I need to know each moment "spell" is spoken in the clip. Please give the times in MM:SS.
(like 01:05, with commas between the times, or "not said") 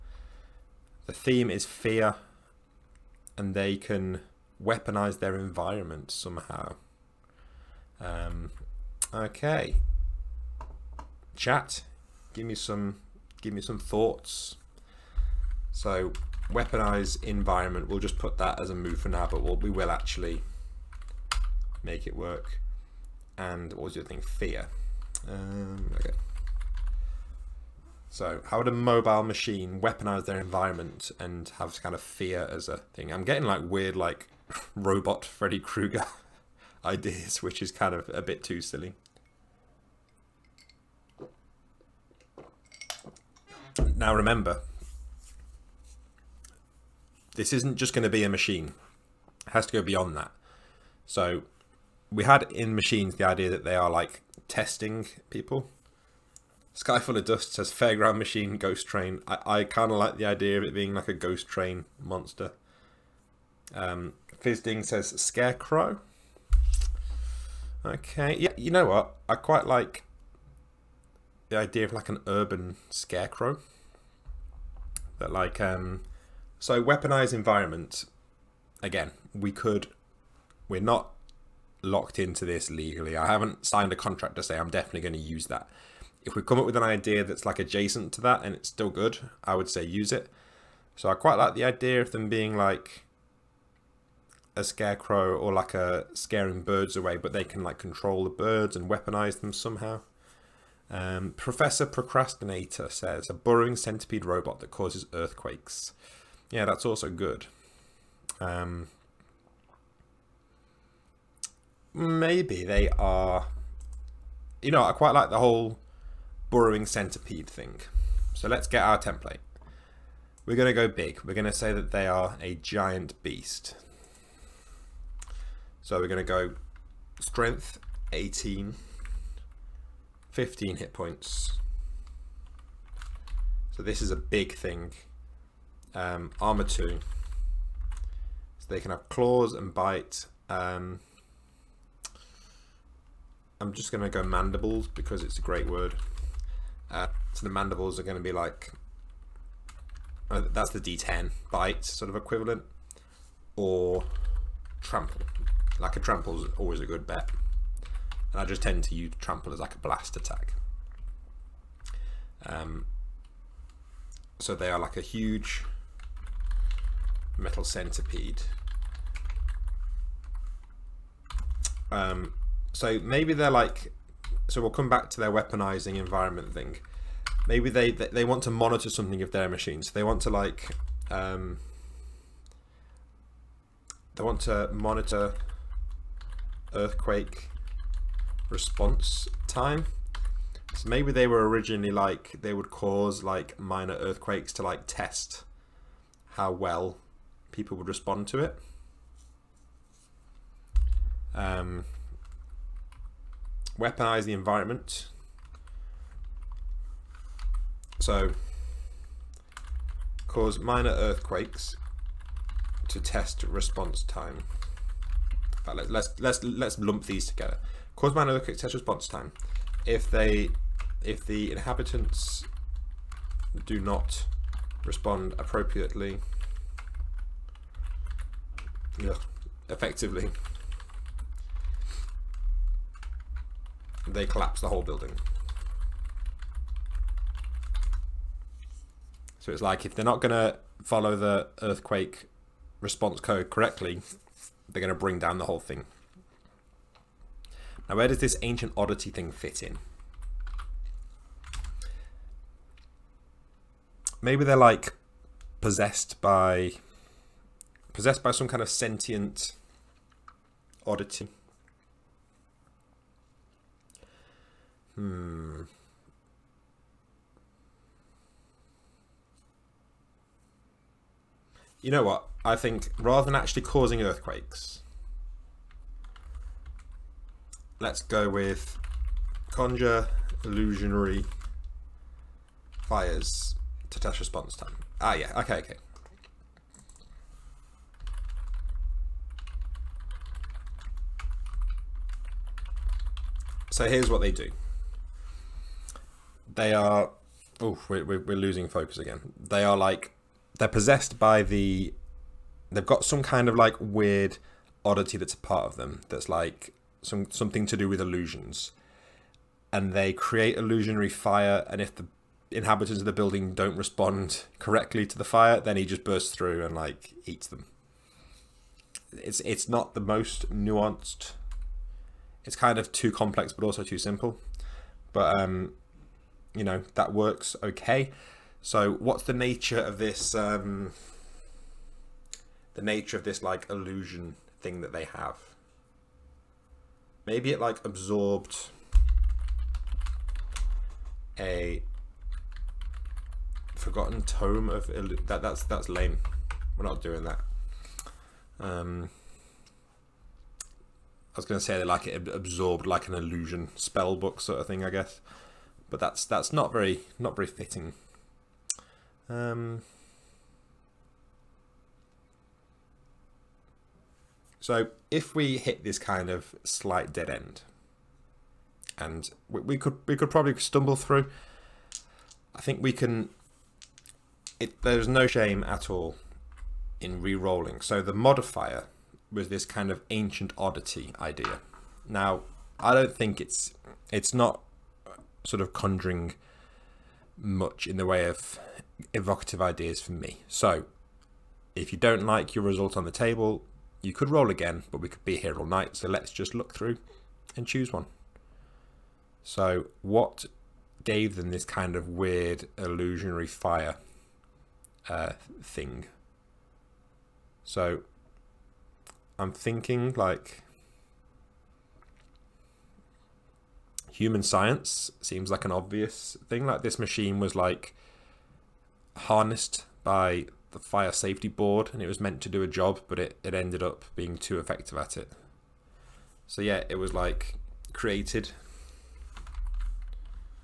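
05:53.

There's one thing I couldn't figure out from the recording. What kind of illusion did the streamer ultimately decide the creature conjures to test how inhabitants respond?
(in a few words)
illusionary fires.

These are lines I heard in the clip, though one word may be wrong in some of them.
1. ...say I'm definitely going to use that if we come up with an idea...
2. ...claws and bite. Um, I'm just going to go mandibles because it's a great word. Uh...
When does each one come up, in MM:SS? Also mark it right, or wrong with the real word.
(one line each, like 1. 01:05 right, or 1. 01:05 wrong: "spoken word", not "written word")
1. 01:24 right
2. 02:19 right.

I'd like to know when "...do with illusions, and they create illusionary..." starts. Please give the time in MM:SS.
05:07.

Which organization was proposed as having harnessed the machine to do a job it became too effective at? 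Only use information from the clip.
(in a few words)
fire safety board.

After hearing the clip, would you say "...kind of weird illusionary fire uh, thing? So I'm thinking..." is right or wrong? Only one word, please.
right.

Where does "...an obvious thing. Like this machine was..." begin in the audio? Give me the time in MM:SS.
06:55.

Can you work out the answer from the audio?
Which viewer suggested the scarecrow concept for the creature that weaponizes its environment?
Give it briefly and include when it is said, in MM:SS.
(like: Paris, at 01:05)
Fizding, at 01:04.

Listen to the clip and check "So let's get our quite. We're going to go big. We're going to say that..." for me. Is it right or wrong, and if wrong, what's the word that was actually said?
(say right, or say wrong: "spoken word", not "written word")
wrong: "template", not "quite".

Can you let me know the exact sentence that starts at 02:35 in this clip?
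Like a trample is always a good bet.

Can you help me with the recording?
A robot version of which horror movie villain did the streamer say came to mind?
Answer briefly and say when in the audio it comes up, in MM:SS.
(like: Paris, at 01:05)
Freddy Krueger, at 00:35.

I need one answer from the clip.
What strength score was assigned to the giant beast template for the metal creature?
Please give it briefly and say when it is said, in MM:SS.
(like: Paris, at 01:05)
18, at 02:07.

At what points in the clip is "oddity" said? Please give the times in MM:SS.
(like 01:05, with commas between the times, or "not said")
04:08, 04:20, 05:04, 06:20.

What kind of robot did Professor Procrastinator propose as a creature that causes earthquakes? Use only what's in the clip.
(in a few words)
burrowing centipede robot.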